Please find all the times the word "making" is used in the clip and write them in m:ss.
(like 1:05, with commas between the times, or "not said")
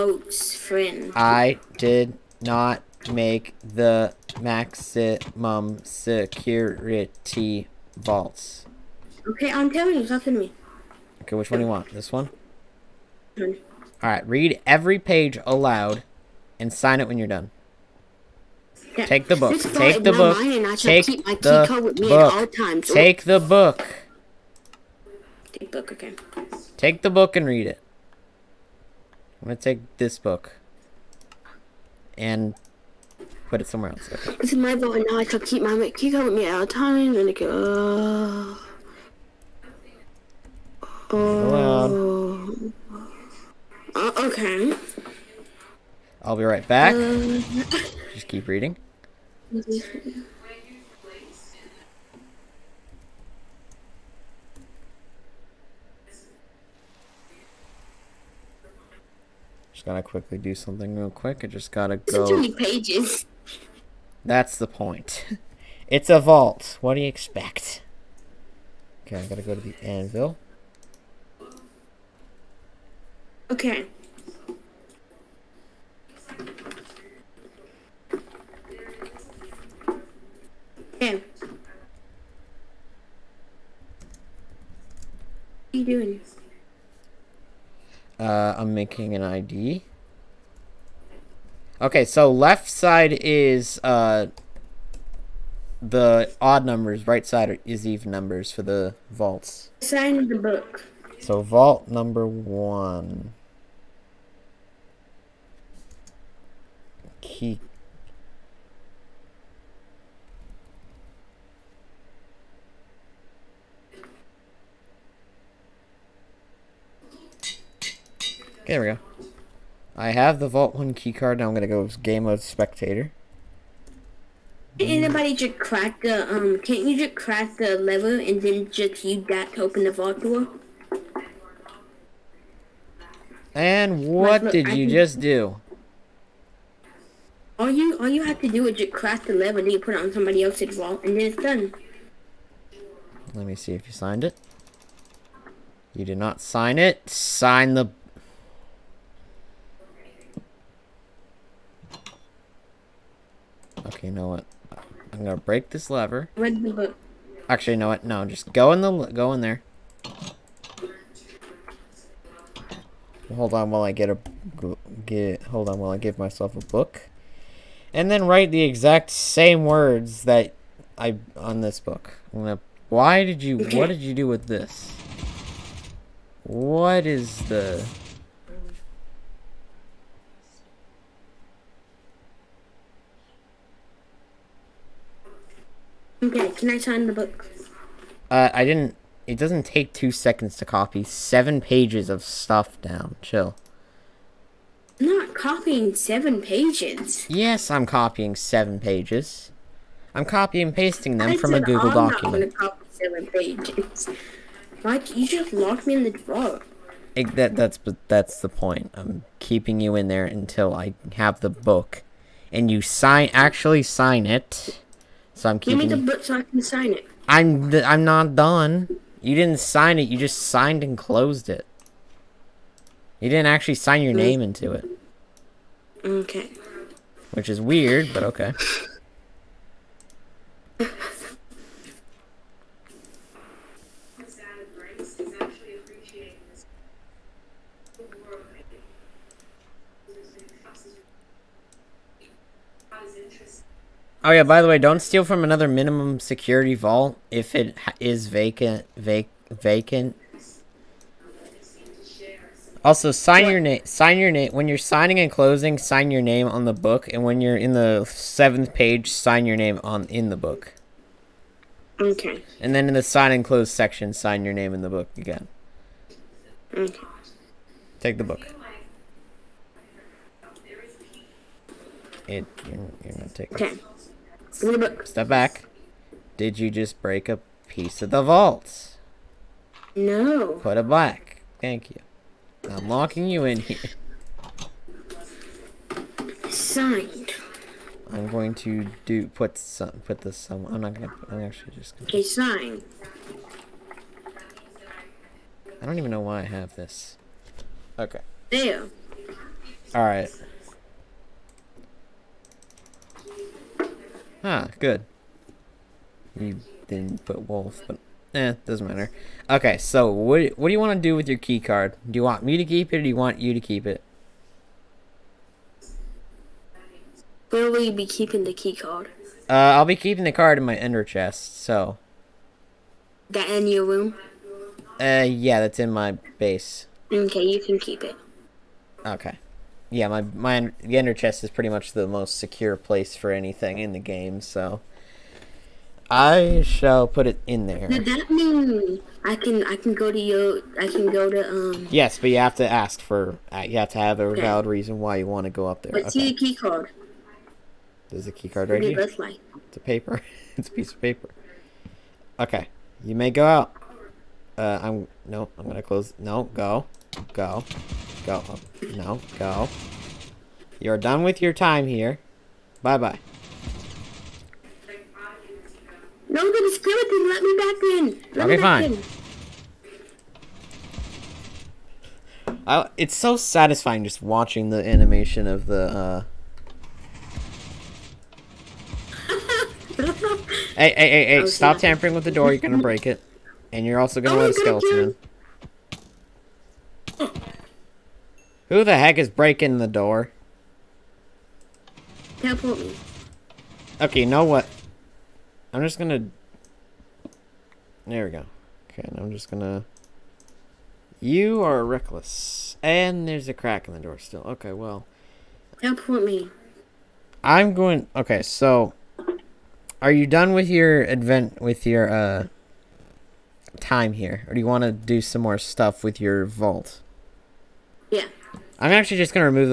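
1:28.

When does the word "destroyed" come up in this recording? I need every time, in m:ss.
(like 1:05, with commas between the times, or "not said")
not said.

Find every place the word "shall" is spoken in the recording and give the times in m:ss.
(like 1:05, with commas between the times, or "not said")
0:35, 5:36.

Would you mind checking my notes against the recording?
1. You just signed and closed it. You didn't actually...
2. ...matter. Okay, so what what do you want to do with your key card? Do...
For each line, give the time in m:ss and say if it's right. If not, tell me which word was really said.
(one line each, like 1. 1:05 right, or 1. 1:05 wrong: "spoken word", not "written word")
1. 3:40 right
2. 5:08 right.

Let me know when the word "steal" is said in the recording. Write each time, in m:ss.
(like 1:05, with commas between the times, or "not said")
4:05.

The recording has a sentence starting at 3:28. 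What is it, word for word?
I'm keeping you in there until I have the book, and you sign actually sign it so I'm keeping.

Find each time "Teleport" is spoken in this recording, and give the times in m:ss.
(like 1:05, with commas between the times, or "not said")
6:32, 6:45.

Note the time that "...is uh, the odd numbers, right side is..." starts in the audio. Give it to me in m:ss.
1:33.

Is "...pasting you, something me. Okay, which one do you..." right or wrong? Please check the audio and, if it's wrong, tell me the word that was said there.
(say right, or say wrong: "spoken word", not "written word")
wrong: "telling", not "pasting".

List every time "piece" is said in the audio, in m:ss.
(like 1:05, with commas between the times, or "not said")
4:37, 5:50.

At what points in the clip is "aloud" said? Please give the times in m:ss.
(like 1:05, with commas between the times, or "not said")
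0:15.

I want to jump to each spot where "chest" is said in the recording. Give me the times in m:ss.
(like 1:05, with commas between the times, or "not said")
5:21, 5:31.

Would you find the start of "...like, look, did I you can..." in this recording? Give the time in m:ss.
2:14.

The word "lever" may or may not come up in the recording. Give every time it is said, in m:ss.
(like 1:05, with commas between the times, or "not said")
2:07, 2:19, 2:35.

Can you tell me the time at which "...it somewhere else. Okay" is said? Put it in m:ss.
0:33.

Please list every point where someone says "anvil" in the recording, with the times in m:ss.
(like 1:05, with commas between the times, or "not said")
1:09.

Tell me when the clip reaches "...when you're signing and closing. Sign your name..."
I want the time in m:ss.
4:14.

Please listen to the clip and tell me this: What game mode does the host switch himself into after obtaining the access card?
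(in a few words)
Spectator.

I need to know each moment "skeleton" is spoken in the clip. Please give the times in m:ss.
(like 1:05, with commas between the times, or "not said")
6:06, 6:24.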